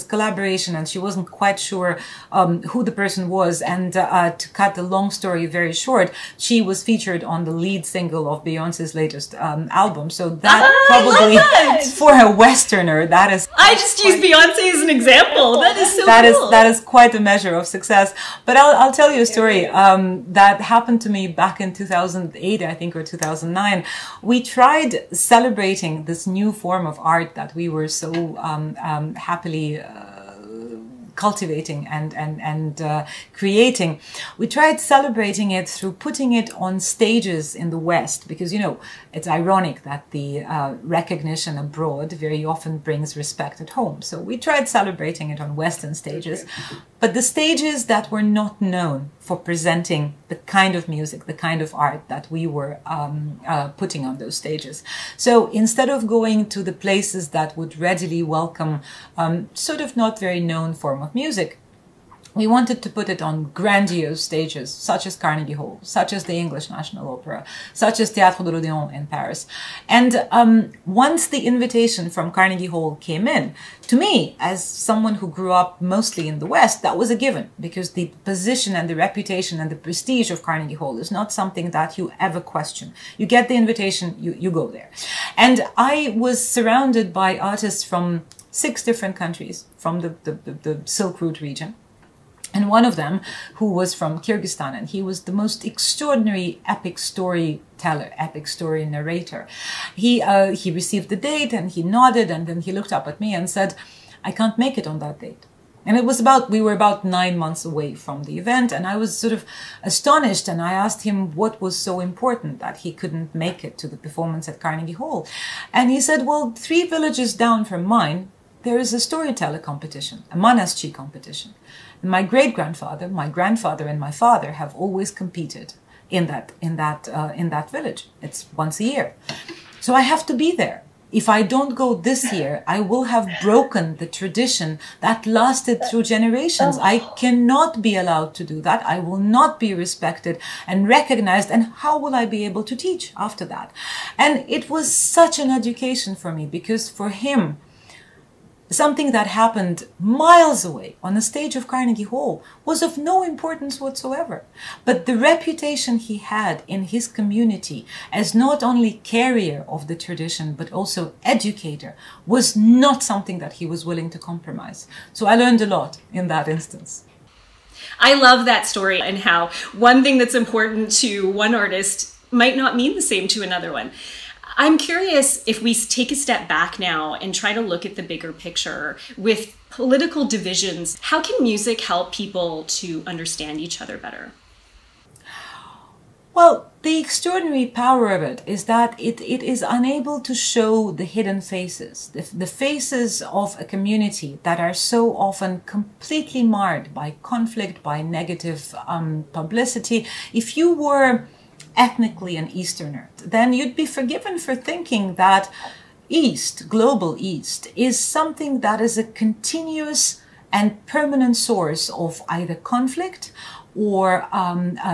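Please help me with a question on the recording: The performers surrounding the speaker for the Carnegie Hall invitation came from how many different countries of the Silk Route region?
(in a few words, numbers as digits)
6.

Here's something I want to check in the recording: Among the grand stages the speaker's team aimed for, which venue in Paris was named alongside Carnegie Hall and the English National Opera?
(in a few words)
Théâtre de l'Odéon.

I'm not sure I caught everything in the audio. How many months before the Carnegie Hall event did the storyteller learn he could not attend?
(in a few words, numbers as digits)
9.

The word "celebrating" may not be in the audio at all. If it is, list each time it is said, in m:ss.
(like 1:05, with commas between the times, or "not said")
0:25, 0:34, 0:44.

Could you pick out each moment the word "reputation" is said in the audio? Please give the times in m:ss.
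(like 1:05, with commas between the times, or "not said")
1:18, 2:35.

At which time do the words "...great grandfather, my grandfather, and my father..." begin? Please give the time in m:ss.
2:02.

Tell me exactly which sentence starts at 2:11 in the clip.
If I don't go this year, I will have broken the tradition that lasted through generations.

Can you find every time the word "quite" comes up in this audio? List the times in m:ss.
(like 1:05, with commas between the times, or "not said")
0:01, 0:16.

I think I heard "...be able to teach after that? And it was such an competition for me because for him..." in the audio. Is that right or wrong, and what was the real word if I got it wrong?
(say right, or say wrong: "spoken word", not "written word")
wrong: "education", not "competition".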